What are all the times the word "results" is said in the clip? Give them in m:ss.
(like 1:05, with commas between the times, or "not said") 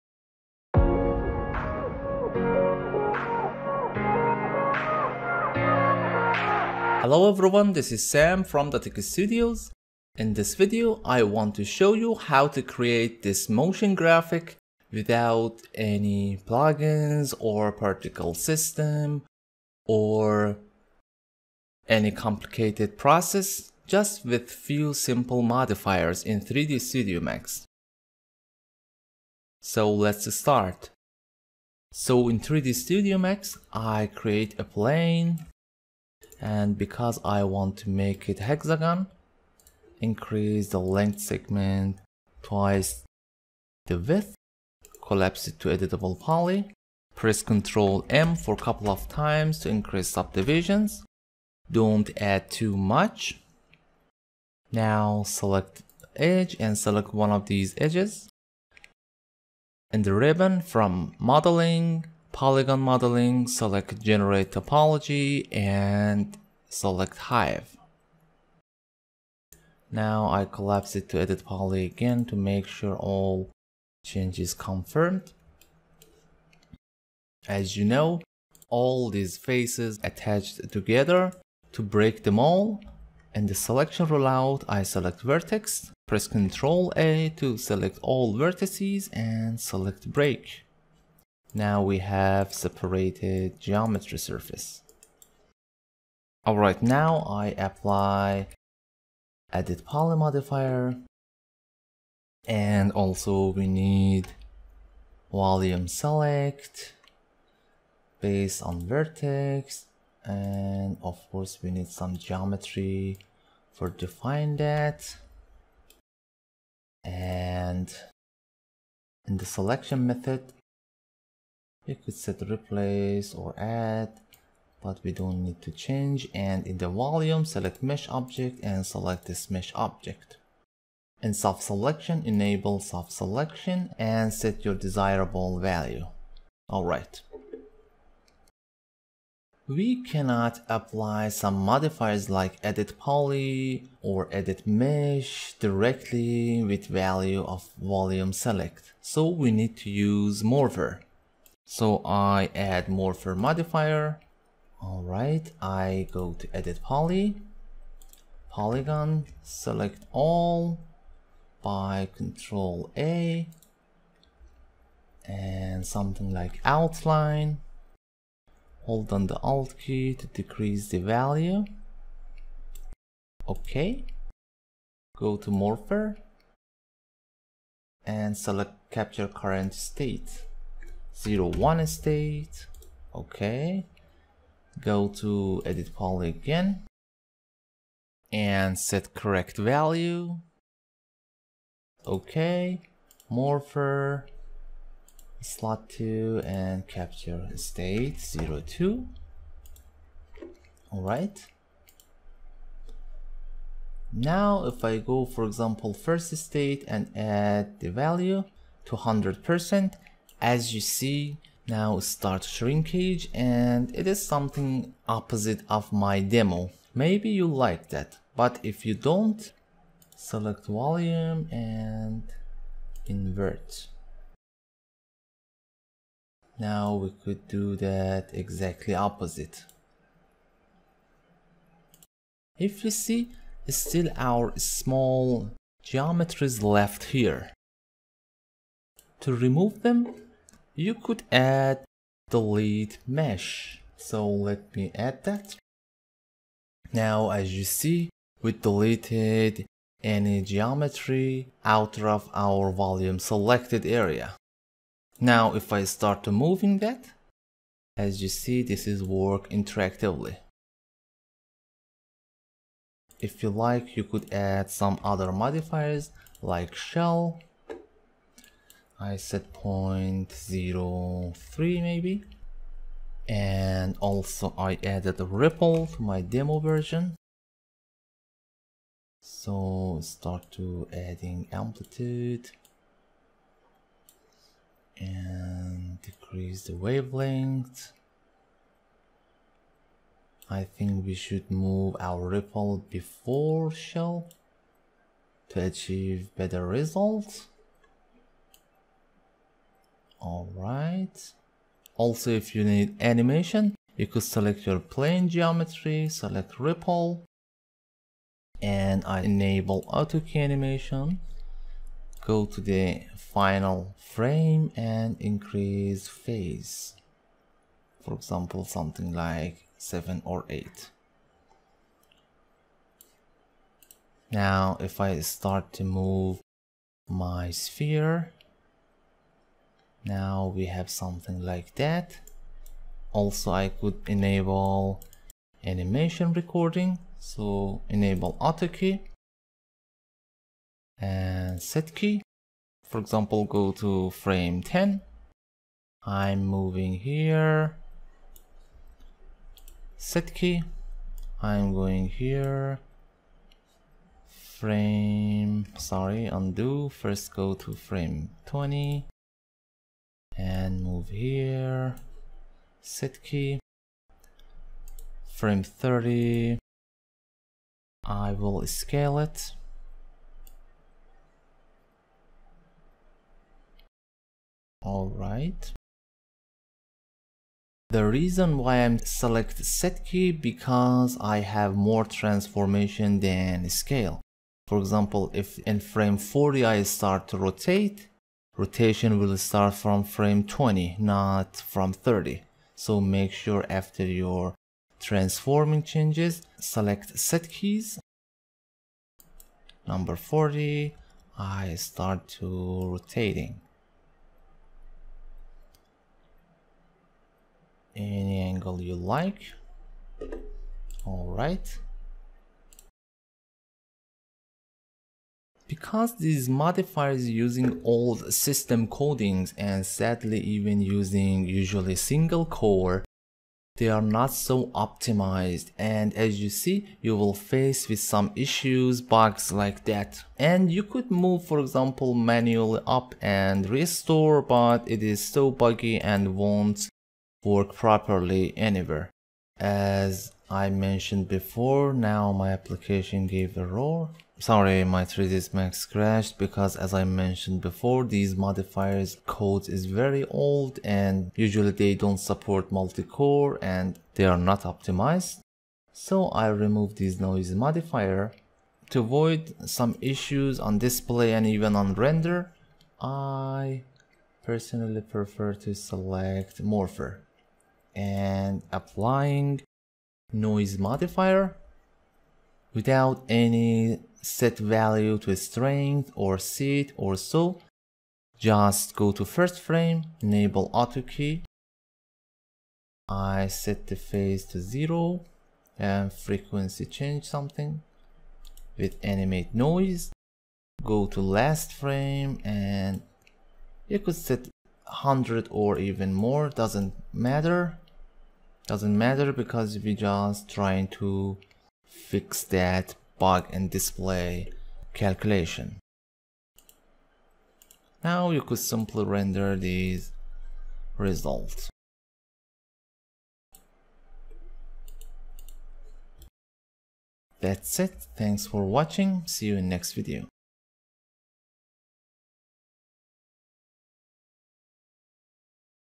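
4:56, 8:30.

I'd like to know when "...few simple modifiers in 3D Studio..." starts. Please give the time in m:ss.
0:24.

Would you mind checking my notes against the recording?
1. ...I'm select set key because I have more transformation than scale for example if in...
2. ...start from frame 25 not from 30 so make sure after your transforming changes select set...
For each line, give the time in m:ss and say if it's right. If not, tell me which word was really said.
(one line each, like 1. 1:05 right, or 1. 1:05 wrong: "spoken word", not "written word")
1. 6:18 right
2. 6:29 wrong: "20", not "25".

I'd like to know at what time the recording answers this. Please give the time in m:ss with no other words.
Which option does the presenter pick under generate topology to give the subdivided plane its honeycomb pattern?
1:07.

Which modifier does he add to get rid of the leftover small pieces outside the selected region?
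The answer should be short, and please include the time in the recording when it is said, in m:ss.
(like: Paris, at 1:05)
delete mesh, at 4:02.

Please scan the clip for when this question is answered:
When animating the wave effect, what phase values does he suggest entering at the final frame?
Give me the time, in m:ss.
5:19.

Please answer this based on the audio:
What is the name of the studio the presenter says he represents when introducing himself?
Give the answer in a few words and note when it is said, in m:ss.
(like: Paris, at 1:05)
Datec Studios, at 0:08.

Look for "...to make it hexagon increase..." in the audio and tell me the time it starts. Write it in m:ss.
0:37.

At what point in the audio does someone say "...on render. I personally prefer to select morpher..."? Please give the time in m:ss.
7:41.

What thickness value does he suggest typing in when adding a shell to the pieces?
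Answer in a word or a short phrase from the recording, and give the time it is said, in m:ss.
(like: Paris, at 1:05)
0.03, at 4:29.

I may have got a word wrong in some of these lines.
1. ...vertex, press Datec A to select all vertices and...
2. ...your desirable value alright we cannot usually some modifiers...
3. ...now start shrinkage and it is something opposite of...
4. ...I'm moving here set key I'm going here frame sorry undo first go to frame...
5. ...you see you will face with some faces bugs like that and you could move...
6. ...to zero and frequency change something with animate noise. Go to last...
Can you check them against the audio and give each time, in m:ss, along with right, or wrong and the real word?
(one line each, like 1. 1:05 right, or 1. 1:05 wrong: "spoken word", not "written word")
1. 1:25 wrong: "Ctrl", not "Datec"
2. 2:14 wrong: "apply", not "usually"
3. 3:31 right
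4. 5:46 right
5. 7:06 wrong: "issues", not "faces"
6. 8:04 right.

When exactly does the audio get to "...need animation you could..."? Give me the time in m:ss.
5:02.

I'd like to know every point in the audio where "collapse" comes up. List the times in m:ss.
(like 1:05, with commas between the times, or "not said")
0:45, 1:10.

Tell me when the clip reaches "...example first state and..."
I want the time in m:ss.
3:25.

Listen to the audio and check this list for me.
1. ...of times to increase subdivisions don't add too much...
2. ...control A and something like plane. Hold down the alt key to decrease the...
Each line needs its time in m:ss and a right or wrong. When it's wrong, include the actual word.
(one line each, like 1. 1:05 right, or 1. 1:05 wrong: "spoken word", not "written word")
1. 0:48 right
2. 2:42 wrong: "outline", not "plane".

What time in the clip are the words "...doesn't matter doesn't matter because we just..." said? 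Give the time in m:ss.
8:16.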